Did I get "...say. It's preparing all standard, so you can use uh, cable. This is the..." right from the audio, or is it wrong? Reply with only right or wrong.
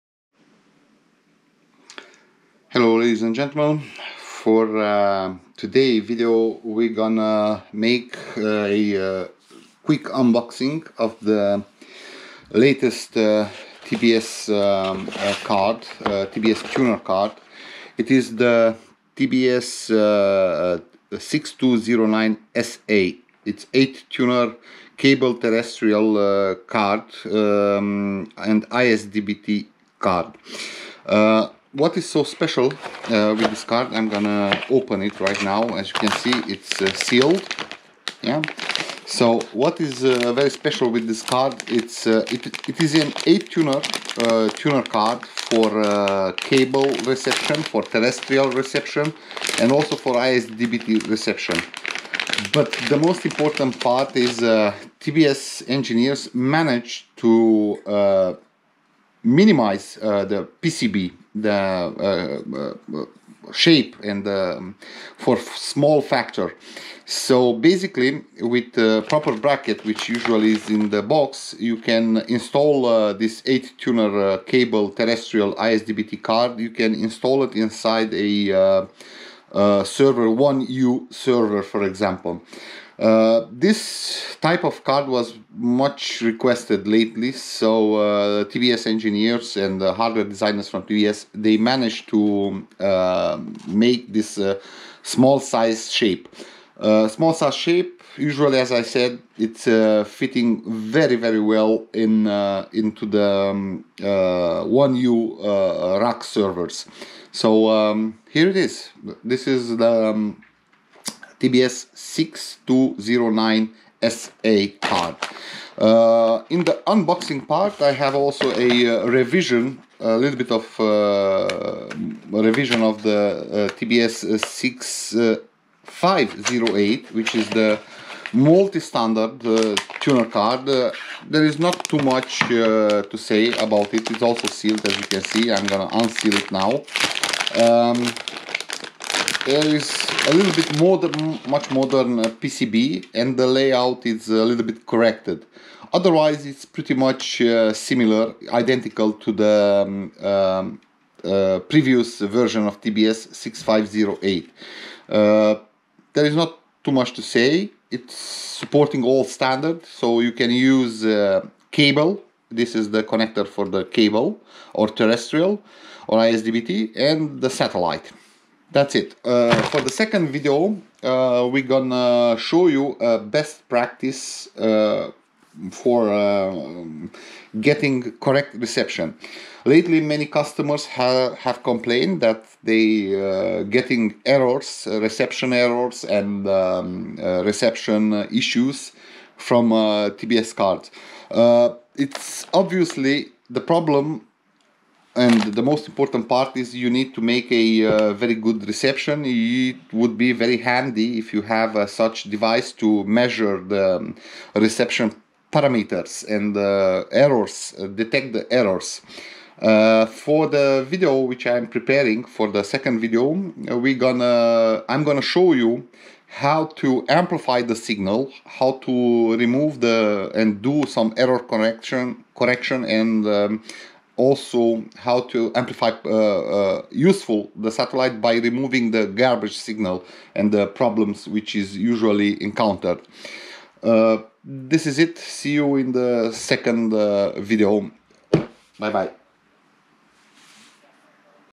wrong.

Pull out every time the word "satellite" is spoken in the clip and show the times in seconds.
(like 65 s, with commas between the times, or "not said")
167 s, 227 s.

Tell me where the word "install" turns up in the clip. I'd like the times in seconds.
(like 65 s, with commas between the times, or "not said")
72 s, 76 s.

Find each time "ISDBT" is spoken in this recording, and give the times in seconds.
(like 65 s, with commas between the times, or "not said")
28 s, 50 s, 75 s, 166 s.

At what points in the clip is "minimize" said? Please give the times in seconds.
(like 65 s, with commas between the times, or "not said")
59 s.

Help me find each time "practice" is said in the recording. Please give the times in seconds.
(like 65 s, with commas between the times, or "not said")
173 s.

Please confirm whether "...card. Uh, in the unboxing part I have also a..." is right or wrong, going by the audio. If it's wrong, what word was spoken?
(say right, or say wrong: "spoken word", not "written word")
right.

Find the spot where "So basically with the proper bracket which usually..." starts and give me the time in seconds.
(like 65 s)
67 s.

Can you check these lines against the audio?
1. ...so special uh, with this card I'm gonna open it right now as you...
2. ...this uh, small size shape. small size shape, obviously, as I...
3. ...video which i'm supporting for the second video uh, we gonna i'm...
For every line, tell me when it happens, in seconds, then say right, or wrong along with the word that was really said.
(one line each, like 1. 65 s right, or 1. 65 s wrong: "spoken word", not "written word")
1. 32 s right
2. 94 s wrong: "usually", not "obviously"
3. 210 s wrong: "preparing", not "supporting".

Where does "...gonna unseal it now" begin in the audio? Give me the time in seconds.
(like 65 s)
135 s.